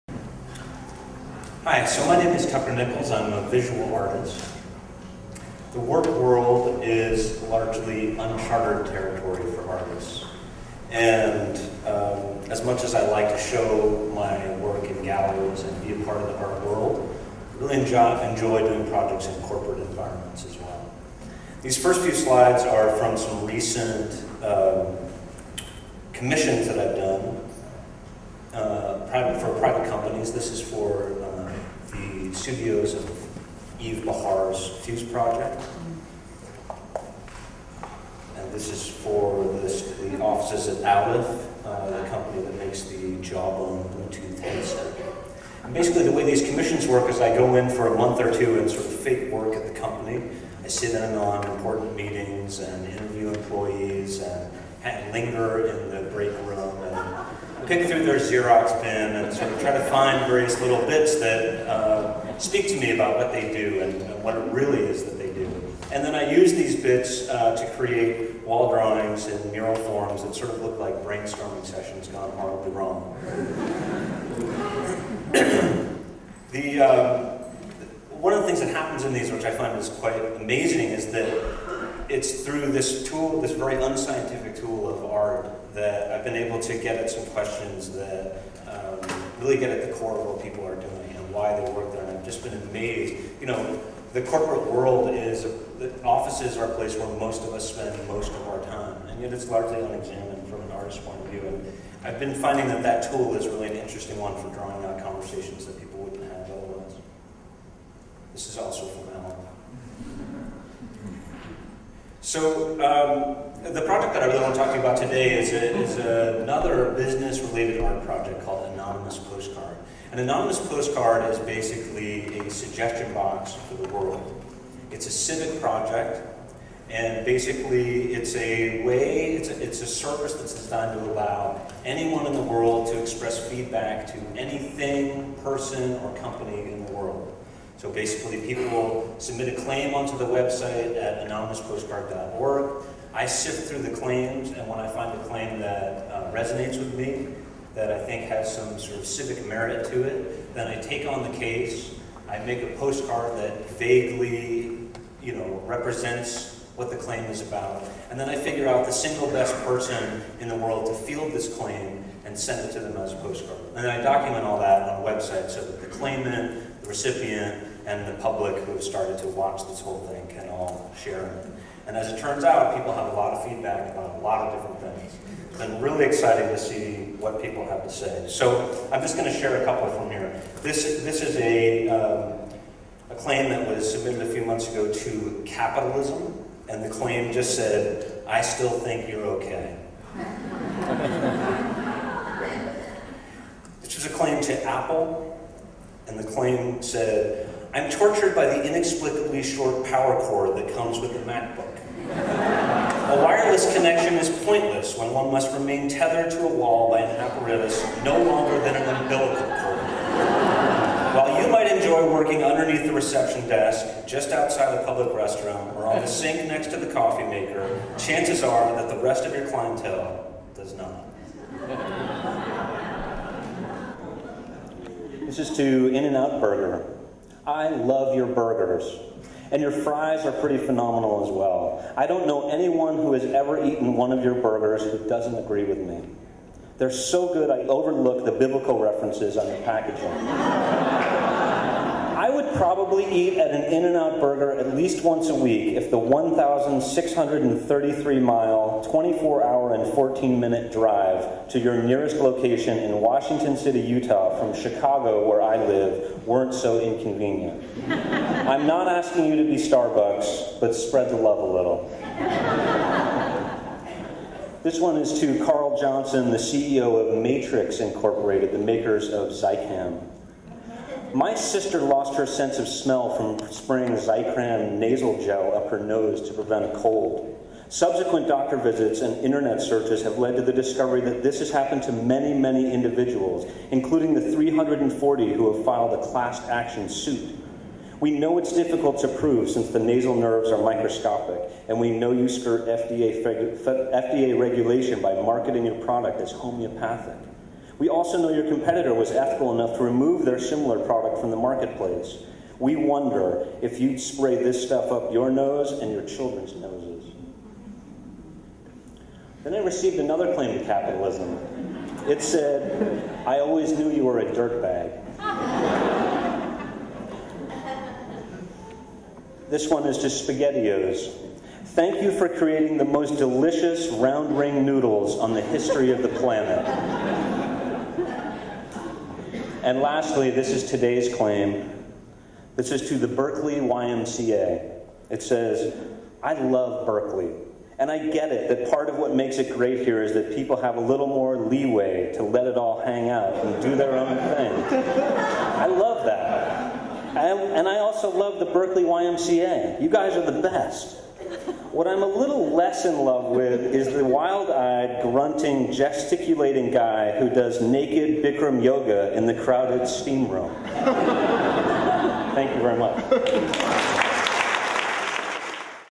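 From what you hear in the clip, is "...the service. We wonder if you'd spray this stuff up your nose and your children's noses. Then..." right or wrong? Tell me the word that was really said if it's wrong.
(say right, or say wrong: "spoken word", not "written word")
wrong: "marketplace", not "service".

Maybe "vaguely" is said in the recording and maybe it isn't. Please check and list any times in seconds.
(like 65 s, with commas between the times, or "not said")
153 s.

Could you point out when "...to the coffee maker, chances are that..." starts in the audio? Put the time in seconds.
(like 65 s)
216 s.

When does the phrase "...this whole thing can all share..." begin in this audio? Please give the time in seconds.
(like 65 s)
169 s.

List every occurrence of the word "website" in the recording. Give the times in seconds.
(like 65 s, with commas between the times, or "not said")
140 s, 165 s.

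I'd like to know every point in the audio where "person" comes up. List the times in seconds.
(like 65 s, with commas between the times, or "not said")
135 s, 159 s.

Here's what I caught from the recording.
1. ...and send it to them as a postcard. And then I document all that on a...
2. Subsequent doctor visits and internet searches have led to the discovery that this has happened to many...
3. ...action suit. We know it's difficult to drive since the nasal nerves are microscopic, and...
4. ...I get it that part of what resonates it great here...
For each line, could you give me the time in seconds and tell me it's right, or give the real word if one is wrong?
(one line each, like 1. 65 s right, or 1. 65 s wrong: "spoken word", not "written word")
1. 162 s right
2. 277 s right
3. 286 s wrong: "prove", not "drive"
4. 337 s wrong: "makes", not "resonates".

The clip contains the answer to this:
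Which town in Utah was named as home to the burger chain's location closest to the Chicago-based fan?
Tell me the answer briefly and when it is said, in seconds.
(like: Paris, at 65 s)
Washington City, at 252 s.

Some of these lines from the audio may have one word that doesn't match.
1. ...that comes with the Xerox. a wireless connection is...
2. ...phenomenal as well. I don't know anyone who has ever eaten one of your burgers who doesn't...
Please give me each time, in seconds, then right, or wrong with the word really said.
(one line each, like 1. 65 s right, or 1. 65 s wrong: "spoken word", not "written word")
1. 200 s wrong: "MacBook", not "Xerox"
2. 230 s right.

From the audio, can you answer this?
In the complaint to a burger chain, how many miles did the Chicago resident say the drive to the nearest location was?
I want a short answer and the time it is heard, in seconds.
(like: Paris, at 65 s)
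1,633, at 245 s.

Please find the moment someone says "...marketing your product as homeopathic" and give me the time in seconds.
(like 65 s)
295 s.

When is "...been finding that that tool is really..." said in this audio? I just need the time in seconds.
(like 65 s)
102 s.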